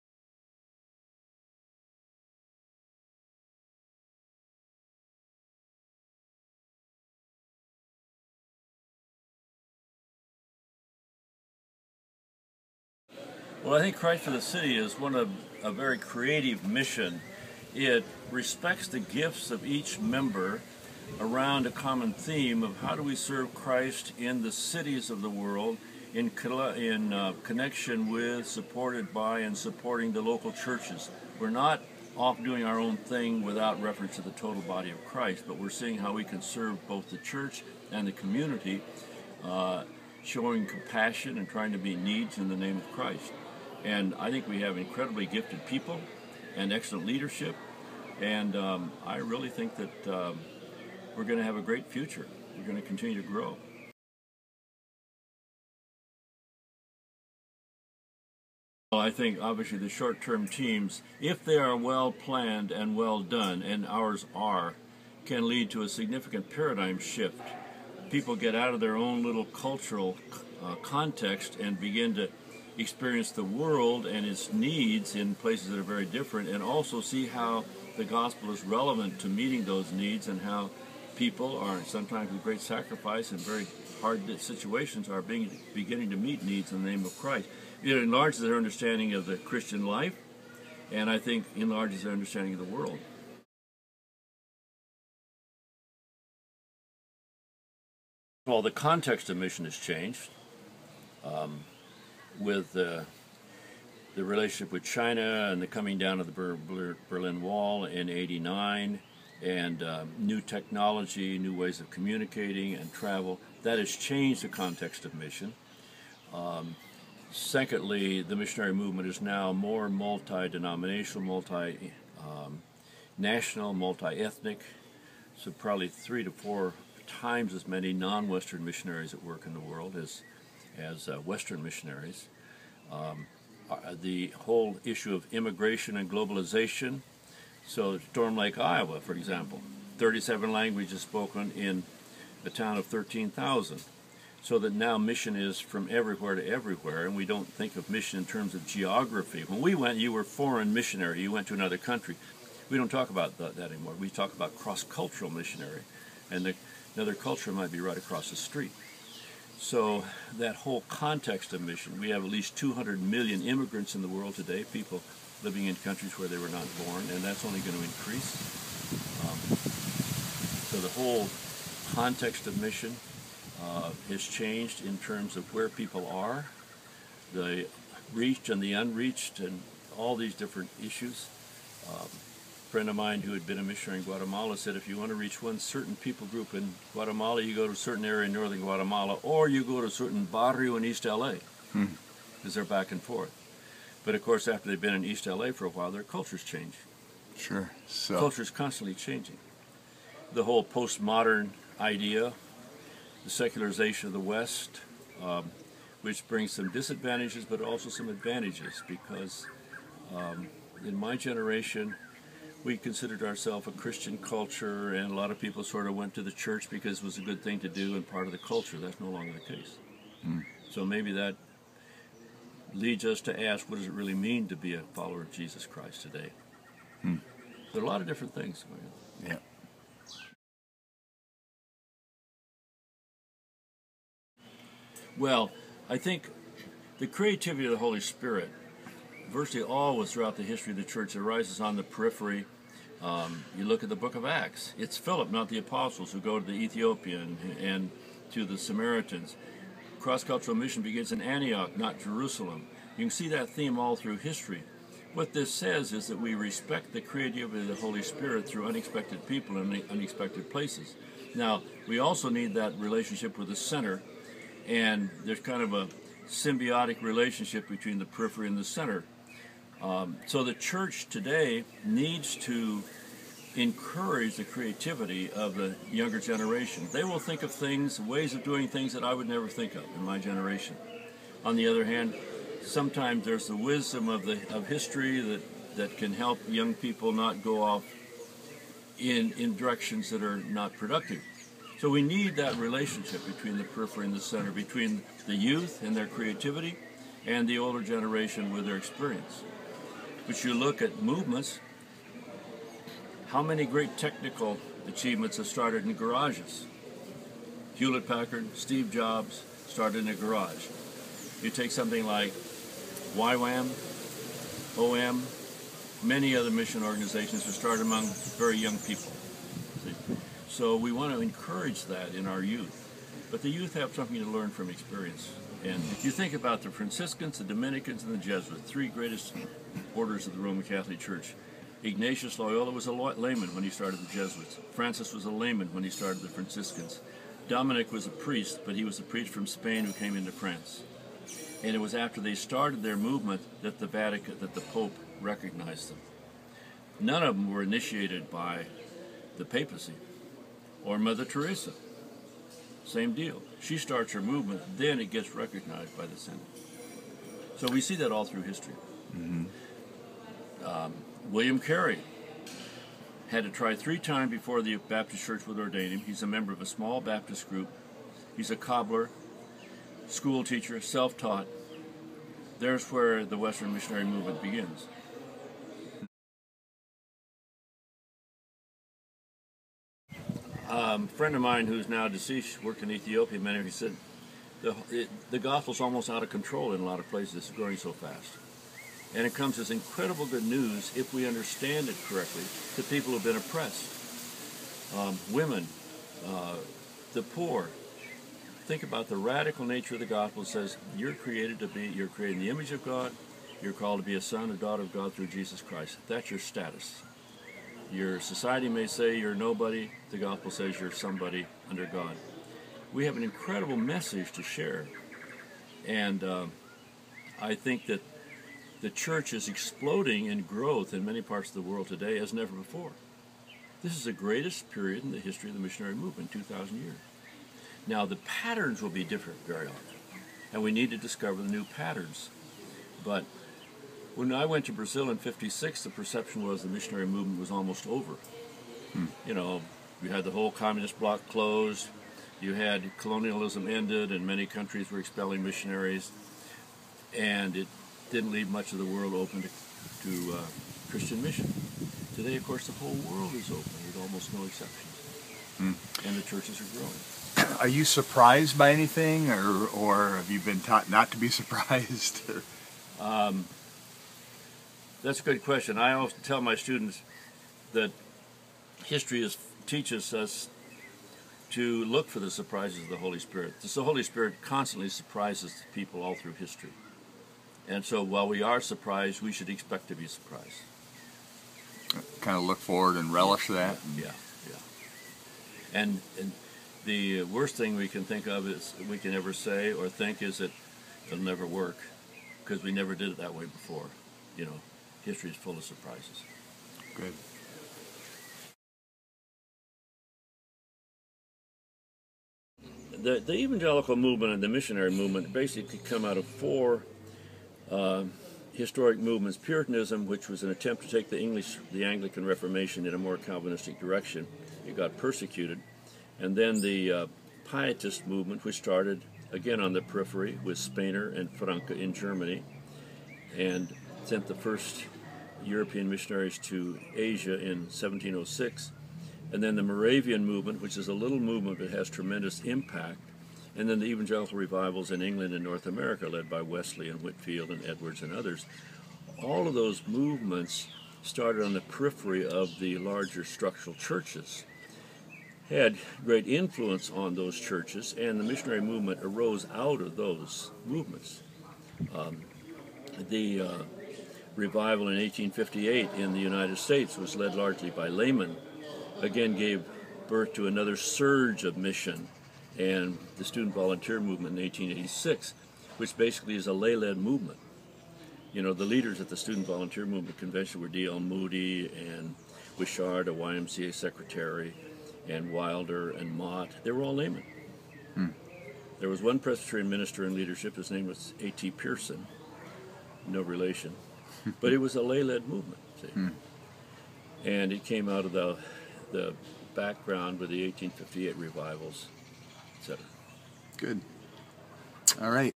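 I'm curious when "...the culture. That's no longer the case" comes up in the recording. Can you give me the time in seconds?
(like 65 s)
218 s.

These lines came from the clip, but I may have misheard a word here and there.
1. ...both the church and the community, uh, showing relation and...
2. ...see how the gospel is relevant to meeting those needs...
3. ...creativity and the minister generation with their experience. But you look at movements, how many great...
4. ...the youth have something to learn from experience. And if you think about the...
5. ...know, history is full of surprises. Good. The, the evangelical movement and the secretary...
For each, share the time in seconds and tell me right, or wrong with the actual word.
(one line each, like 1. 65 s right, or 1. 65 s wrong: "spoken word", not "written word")
1. 36 s wrong: "compassion", not "relation"
2. 77 s right
3. 296 s wrong: "older", not "minister"
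4. 323 s right
5. 494 s wrong: "missionary", not "secretary".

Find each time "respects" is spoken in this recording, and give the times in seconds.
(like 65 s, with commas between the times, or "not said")
18 s, 256 s.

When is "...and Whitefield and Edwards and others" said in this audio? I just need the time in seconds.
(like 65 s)
536 s.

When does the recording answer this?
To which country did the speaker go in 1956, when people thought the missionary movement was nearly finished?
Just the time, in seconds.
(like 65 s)
434 s.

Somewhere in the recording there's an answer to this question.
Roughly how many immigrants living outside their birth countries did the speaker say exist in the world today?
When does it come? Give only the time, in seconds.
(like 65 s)
162 s.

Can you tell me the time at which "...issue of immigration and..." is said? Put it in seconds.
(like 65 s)
134 s.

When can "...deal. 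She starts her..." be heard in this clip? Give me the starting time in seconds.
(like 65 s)
353 s.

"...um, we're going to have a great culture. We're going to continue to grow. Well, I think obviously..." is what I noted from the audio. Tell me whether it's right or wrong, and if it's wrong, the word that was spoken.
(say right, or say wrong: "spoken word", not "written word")
wrong: "future", not "culture".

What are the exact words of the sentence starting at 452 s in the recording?
Today, of course, the whole world is open with almost no exceptions, mm.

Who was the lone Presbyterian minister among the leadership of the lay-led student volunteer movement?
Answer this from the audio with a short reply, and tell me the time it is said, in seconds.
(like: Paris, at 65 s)
A.T. Pierson, at 581 s.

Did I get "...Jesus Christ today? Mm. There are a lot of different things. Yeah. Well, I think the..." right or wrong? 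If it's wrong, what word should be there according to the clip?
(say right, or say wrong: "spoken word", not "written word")
right.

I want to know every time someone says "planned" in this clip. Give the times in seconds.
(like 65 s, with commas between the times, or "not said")
62 s.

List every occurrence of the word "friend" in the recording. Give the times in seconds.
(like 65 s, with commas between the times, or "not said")
182 s, 381 s.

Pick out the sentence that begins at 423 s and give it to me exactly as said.
This is the greatest period in the history of the missionary movement, 2,000 years.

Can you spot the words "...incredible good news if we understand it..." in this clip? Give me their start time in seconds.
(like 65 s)
389 s.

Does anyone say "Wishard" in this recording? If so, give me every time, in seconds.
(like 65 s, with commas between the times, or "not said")
572 s.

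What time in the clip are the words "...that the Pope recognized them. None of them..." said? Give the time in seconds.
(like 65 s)
344 s.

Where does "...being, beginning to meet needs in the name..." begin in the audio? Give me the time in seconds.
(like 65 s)
85 s.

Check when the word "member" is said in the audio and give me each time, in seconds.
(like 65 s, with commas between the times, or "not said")
19 s, 366 s.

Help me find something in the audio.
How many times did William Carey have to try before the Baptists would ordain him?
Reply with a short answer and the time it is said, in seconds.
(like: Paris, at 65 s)
3, at 363 s.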